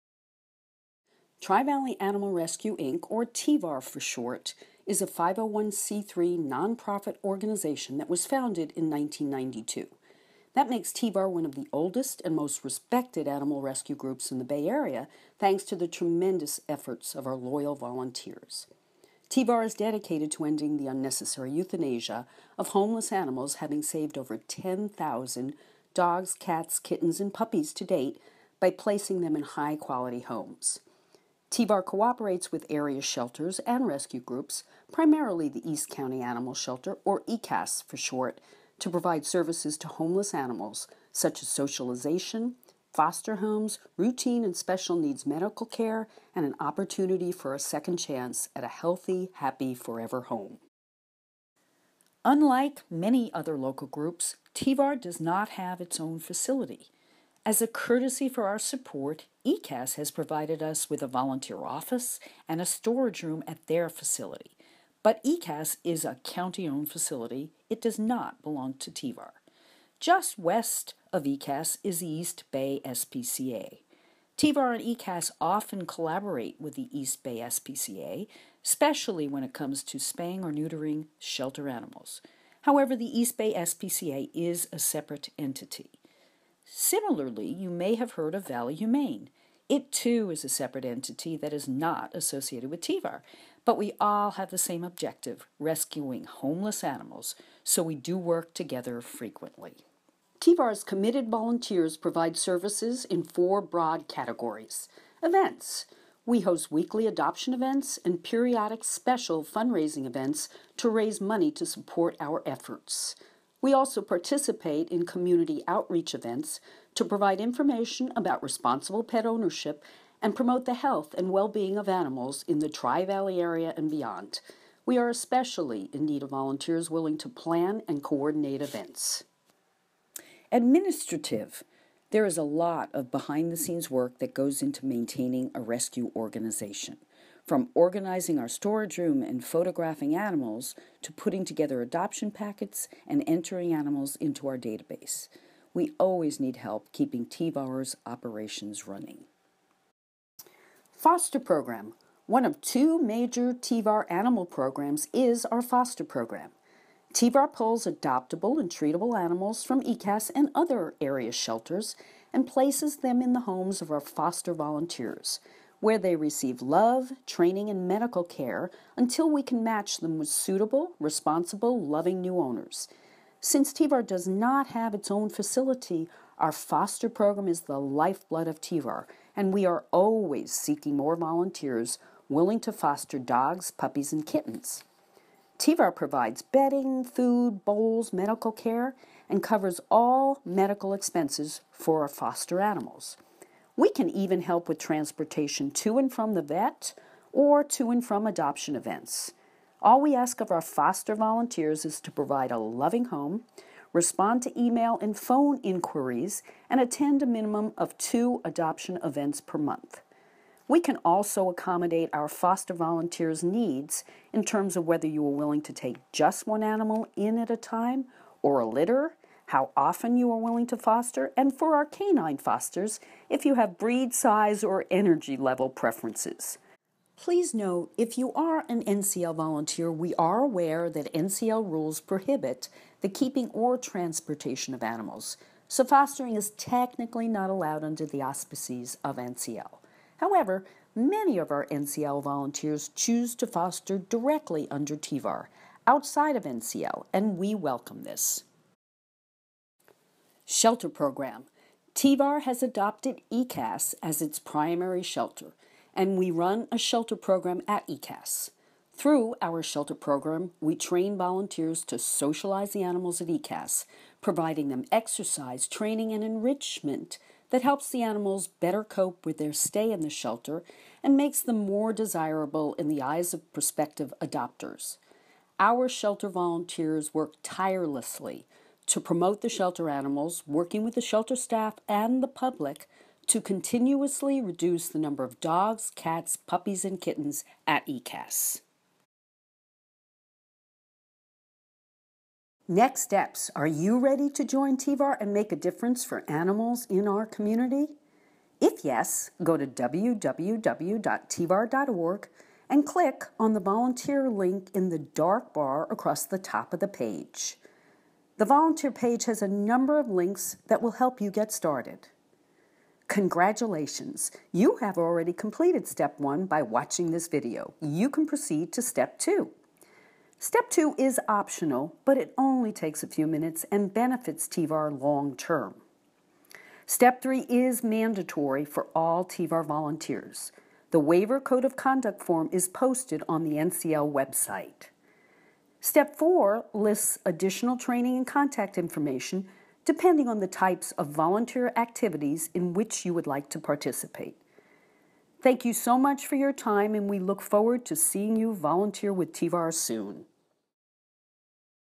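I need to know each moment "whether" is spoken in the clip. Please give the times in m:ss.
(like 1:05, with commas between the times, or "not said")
3:34.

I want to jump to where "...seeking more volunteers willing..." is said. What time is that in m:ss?
3:00.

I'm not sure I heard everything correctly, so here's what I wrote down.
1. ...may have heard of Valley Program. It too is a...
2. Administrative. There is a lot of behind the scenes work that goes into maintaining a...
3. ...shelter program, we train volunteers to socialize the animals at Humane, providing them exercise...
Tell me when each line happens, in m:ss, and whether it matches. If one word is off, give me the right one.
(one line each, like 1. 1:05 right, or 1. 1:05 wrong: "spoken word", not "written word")
1. 1:27 wrong: "Humane", not "Program"
2. 2:10 right
3. 4:19 wrong: "ECAS", not "Humane".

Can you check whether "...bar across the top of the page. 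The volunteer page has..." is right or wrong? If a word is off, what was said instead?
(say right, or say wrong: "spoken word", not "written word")
right.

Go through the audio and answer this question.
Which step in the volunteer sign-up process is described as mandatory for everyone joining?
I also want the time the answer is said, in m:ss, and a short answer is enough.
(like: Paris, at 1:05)
Step three, at 5:26.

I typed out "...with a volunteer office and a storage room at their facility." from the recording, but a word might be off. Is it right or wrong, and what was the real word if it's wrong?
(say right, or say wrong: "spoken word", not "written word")
right.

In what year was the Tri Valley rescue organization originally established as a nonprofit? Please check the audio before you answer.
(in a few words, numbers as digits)
1992.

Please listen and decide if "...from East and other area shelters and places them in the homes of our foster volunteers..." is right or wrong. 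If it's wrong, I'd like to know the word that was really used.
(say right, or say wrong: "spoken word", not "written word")
wrong: "ECAS", not "East".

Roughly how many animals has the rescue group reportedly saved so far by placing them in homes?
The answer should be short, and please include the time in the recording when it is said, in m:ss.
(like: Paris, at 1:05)
10,000, at 0:24.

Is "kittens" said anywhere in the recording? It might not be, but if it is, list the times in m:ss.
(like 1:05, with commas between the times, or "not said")
0:26, 3:04, 4:46.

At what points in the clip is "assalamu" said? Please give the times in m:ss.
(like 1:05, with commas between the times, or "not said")
not said.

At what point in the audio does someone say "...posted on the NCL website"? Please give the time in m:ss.
5:32.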